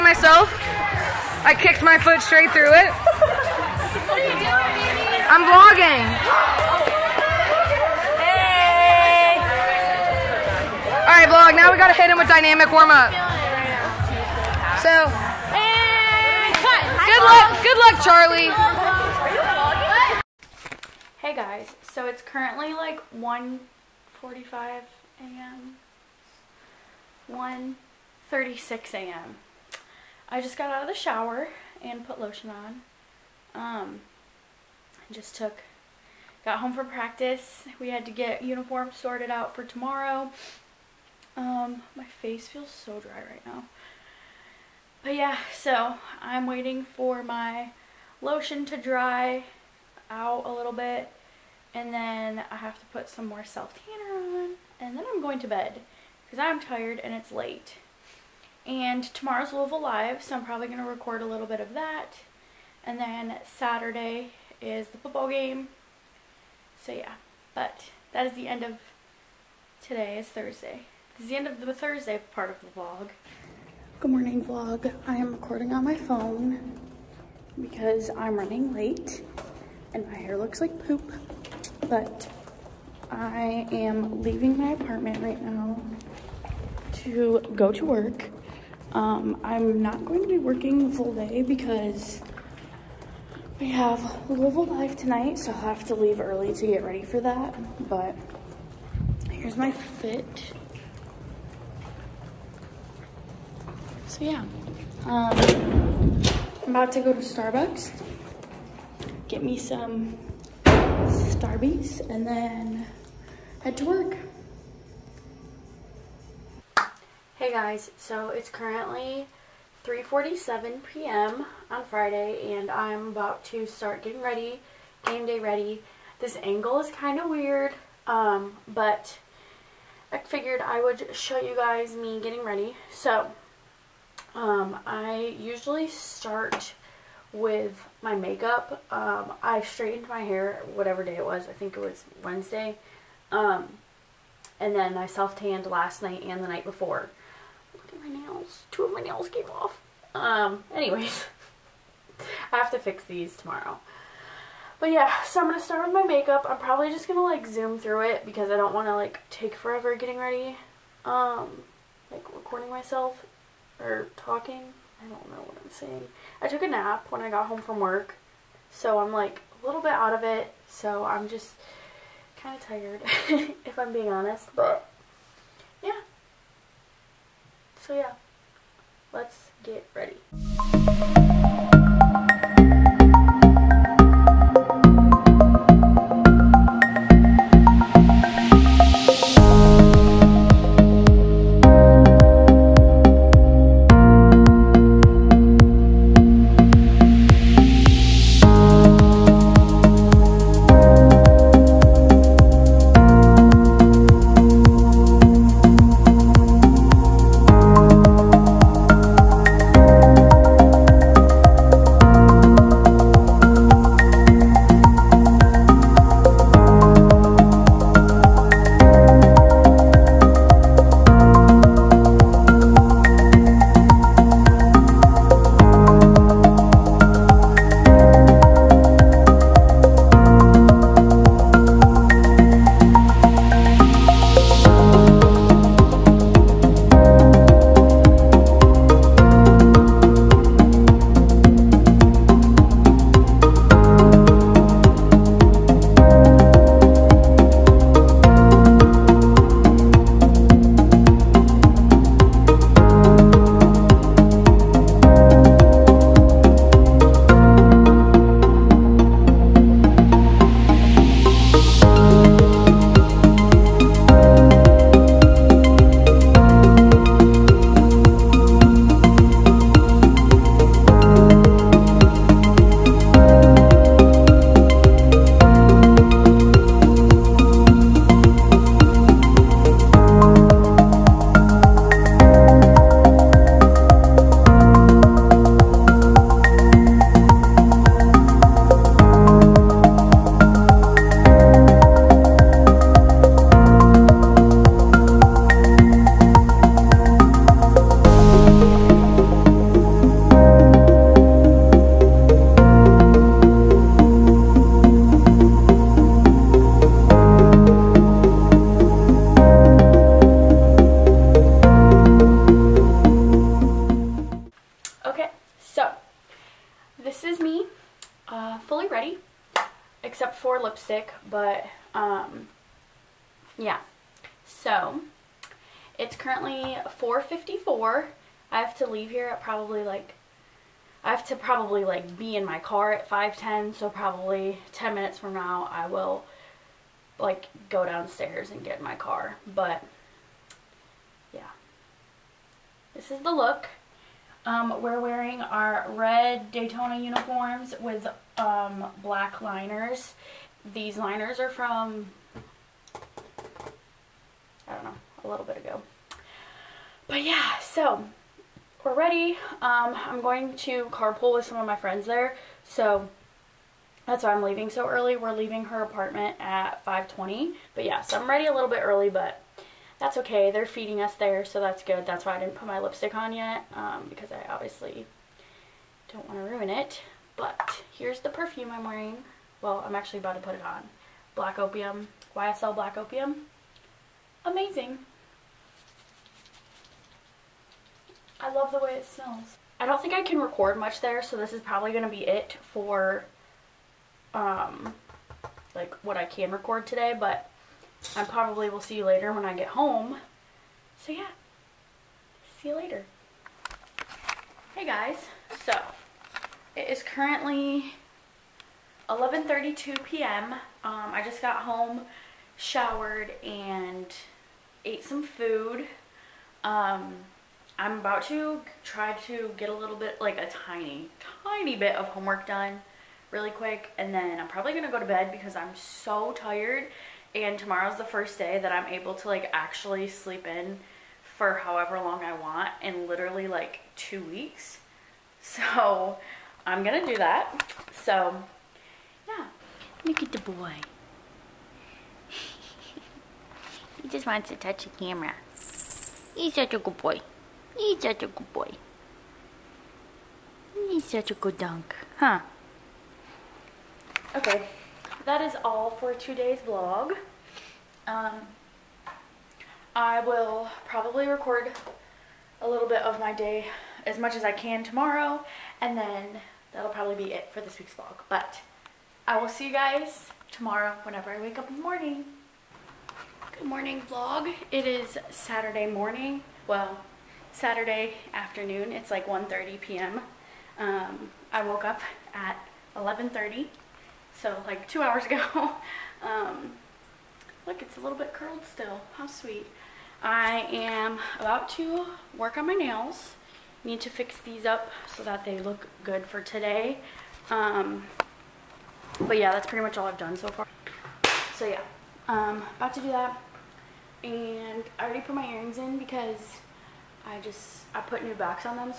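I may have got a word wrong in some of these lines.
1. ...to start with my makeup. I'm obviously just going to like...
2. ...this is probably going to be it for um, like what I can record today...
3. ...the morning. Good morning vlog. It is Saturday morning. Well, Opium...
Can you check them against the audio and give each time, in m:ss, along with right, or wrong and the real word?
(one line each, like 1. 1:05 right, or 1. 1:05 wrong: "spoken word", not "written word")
1. 2:35 wrong: "probably", not "obviously"
2. 6:31 right
3. 7:51 wrong: "Saturday", not "Opium".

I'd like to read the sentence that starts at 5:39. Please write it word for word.
But yeah, this is the look.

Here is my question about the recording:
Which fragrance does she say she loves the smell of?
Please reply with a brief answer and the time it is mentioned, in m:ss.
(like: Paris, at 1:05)
YSL Black Opium, at 6:22.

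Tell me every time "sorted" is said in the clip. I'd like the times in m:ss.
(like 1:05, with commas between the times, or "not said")
0:38.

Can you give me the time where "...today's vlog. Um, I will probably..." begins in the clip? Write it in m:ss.
7:36.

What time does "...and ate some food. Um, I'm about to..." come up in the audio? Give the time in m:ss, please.
6:53.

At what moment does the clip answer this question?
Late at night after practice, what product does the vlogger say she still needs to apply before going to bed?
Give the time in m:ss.
0:53.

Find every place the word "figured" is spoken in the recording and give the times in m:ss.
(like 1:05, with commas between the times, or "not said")
2:10.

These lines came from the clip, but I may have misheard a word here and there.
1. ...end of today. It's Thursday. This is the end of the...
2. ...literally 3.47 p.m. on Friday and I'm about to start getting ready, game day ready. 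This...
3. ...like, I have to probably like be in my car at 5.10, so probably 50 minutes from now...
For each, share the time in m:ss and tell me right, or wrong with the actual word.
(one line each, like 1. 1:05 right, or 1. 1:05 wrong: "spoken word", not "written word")
1. 1:08 right
2. 1:58 wrong: "currently", not "literally"
3. 5:29 wrong: "10", not "50".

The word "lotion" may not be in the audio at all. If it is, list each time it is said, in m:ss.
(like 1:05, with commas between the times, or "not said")
0:32, 0:48.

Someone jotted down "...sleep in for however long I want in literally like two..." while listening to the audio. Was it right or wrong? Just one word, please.
right.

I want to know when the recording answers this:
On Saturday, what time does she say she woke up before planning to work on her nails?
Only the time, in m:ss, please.
8:02.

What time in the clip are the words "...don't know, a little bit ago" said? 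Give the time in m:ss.
5:54.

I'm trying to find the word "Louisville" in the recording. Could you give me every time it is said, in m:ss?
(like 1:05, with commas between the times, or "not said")
0:59, 1:34.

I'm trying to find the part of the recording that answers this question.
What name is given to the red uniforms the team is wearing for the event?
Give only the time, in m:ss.
5:46.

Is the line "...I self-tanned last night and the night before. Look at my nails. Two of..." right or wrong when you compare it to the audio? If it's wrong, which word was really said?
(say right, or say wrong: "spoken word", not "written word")
right.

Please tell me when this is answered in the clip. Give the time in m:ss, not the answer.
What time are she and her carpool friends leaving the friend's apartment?
6:06.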